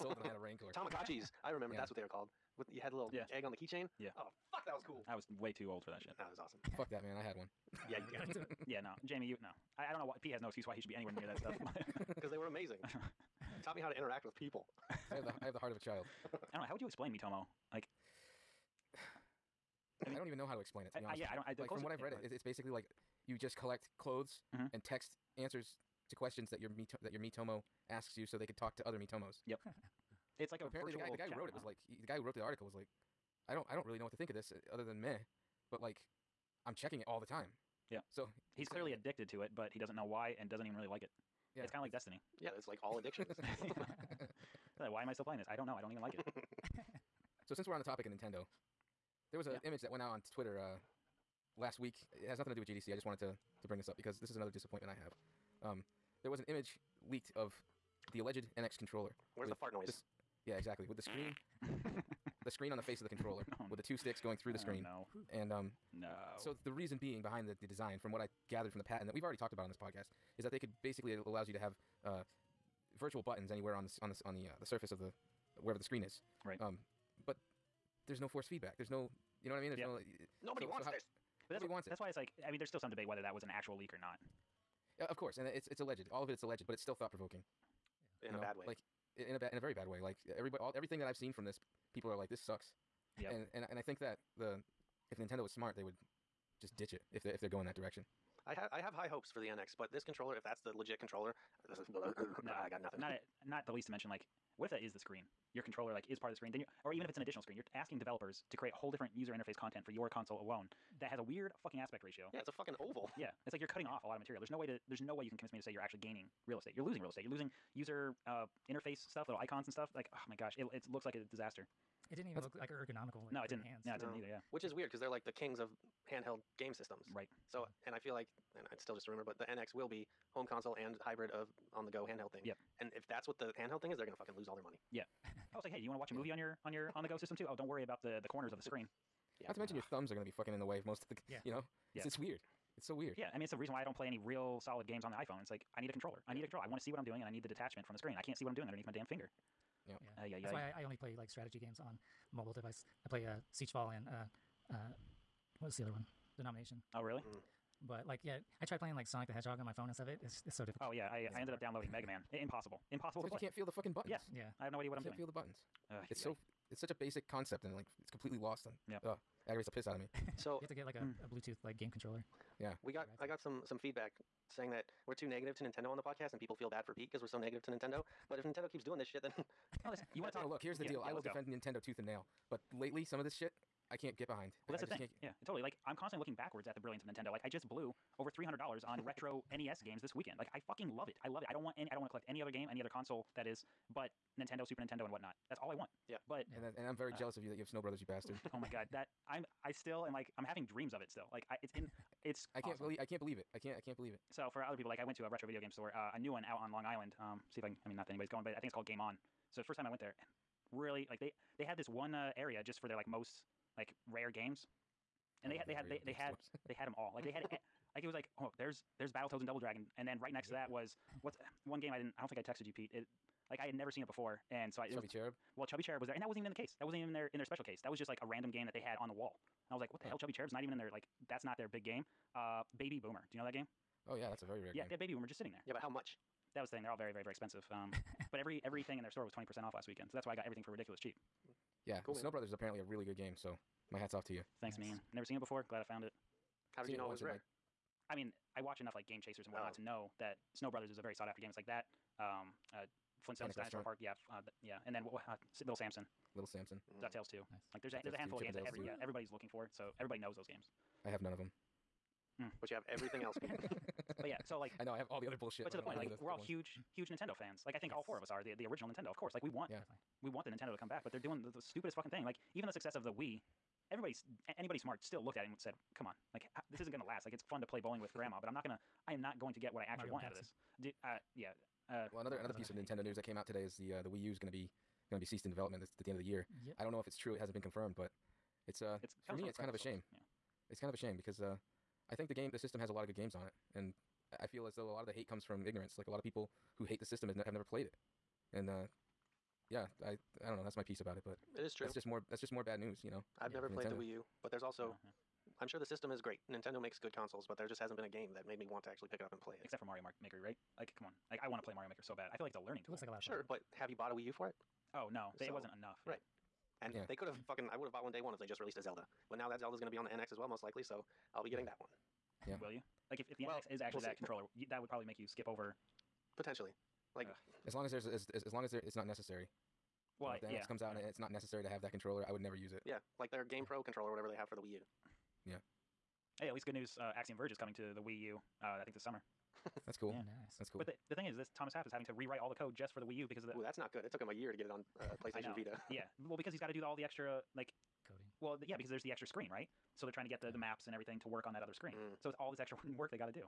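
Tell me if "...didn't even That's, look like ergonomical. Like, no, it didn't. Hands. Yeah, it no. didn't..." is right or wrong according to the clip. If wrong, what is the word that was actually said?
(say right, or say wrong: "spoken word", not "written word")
right.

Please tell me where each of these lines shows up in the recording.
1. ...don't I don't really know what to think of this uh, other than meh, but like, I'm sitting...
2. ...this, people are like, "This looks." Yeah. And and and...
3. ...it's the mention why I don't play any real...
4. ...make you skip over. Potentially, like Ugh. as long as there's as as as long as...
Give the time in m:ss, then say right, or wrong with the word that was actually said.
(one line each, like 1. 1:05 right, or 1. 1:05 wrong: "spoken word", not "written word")
1. 0:33 wrong: "checking", not "sitting"
2. 1:31 wrong: "sucks", not "looks"
3. 2:23 wrong: "reason", not "mention"
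4. 5:25 right.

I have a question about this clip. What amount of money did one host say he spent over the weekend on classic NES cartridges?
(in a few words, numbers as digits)
$300.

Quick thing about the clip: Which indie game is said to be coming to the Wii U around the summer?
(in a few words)
Axiom Verge.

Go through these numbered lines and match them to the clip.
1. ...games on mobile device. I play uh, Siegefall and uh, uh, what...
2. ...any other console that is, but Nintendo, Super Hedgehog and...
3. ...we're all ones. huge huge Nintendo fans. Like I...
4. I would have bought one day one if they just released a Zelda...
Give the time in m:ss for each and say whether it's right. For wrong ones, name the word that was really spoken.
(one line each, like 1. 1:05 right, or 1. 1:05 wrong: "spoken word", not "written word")
1. 2:31 right
2. 3:12 wrong: "Nintendo", not "Hedgehog"
3. 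4:26 right
4. 5:17 right.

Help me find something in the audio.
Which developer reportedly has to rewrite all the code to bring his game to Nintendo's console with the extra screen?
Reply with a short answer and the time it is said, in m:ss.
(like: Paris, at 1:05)
Thomas Happ, at 5:41.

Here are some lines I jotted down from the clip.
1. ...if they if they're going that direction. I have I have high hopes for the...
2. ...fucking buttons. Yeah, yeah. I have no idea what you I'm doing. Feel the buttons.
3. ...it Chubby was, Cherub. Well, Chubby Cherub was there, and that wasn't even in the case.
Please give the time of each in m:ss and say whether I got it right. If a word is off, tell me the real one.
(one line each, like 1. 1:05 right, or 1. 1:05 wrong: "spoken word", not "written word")
1. 1:37 right
2. 2:43 right
3. 3:44 right.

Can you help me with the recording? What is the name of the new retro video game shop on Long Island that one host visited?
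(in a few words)
Game On.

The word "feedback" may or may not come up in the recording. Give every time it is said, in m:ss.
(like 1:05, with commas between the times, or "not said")
1:18, 2:53.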